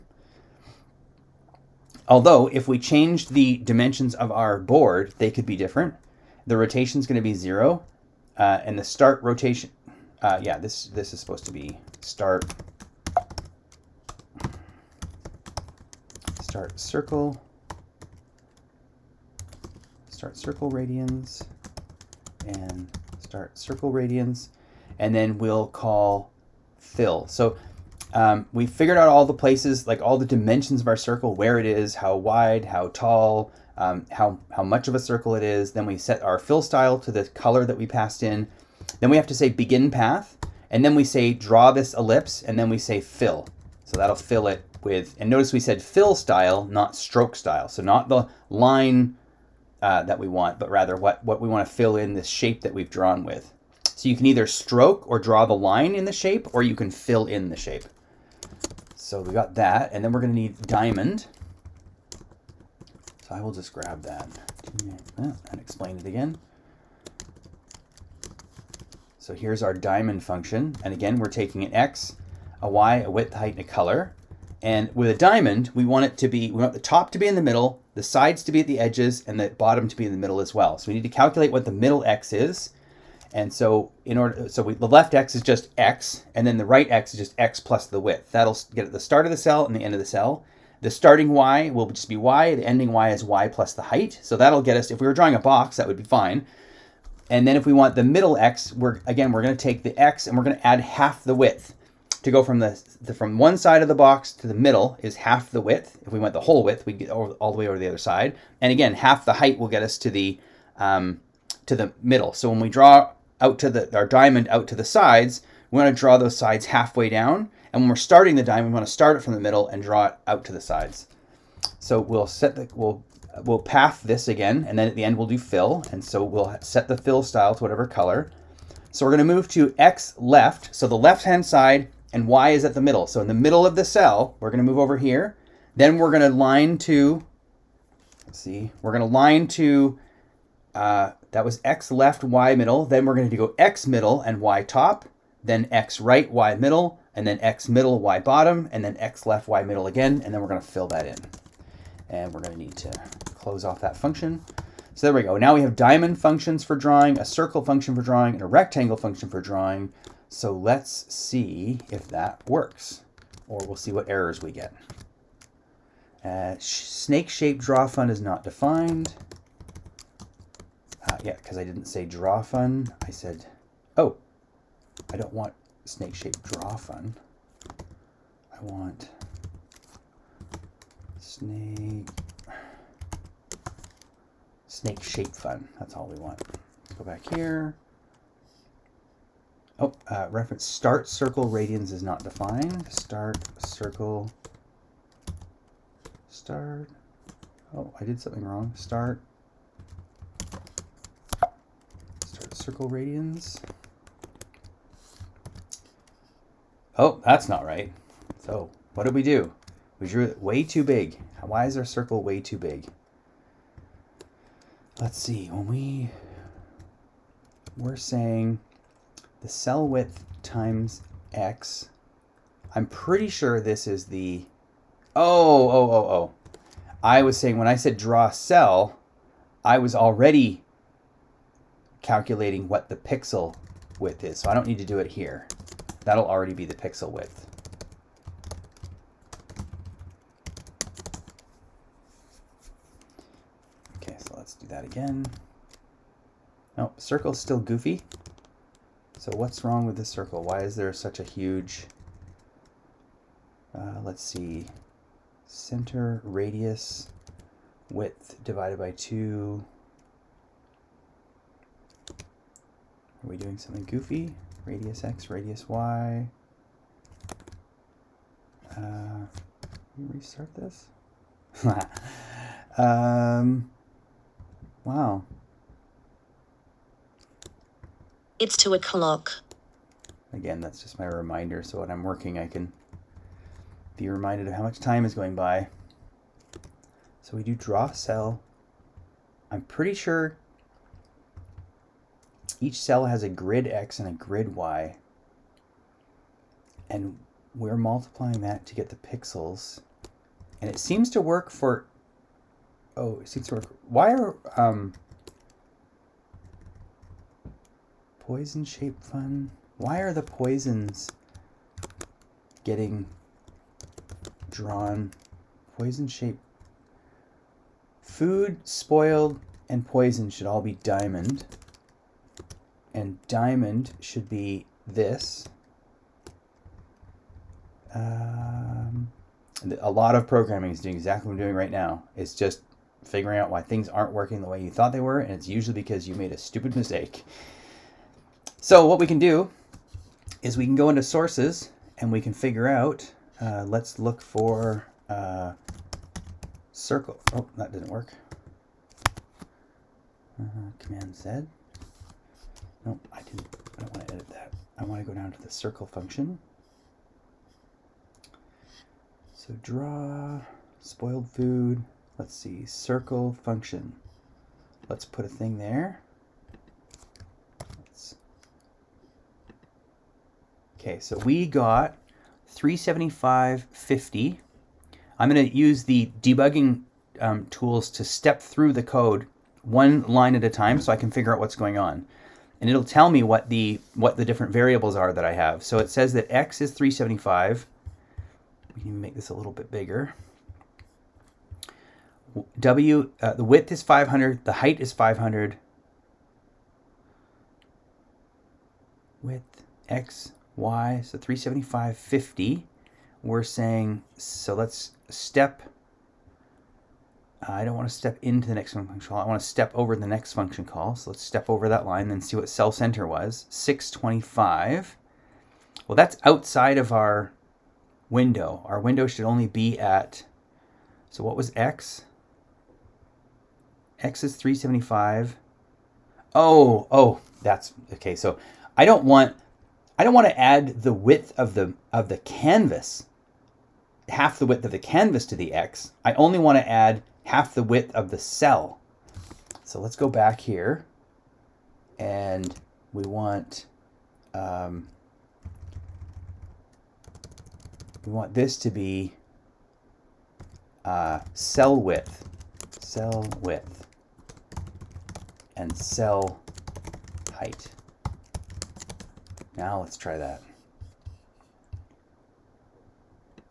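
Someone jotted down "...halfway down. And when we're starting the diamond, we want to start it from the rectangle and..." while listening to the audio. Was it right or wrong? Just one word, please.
wrong.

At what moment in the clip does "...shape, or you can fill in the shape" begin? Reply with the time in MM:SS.
00:56.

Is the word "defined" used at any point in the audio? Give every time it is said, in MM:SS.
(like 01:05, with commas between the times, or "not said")
02:48, 03:12.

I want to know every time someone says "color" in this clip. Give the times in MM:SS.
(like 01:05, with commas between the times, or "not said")
00:37, 01:13, 02:07.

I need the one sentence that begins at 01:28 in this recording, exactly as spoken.
That'll get at the start of the cell and the end of the cell.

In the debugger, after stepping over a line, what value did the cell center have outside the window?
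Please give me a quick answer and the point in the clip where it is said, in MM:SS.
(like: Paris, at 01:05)
625, at 06:53.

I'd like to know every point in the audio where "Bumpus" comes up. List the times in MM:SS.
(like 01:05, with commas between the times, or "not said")
not said.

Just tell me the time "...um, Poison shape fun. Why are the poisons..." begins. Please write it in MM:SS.
05:04.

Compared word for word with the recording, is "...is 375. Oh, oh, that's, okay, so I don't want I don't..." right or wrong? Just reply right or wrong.
right.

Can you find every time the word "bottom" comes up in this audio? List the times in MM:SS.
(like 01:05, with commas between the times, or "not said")
01:19, 02:28.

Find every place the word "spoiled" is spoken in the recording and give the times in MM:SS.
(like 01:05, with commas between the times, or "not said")
05:18, 06:00.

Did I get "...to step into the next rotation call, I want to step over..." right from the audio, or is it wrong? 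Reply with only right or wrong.
wrong.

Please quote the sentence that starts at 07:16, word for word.
I only want to add half the width of the cell.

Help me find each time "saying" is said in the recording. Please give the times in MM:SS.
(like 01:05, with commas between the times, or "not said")
03:37, 03:47, 06:43.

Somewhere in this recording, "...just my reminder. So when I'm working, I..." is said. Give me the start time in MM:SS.
04:40.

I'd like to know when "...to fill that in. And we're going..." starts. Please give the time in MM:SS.
02:30.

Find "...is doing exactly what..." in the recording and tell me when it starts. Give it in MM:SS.
05:30.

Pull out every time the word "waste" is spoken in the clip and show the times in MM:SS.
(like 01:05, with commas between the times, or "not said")
not said.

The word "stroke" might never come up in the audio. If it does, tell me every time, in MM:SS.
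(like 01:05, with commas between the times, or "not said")
00:46, 00:54.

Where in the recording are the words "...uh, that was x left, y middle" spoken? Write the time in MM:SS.
02:20.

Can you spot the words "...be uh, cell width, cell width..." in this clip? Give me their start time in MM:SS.
07:28.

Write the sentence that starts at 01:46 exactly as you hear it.
If we went the whole width, we'd get over, all the way over the other side.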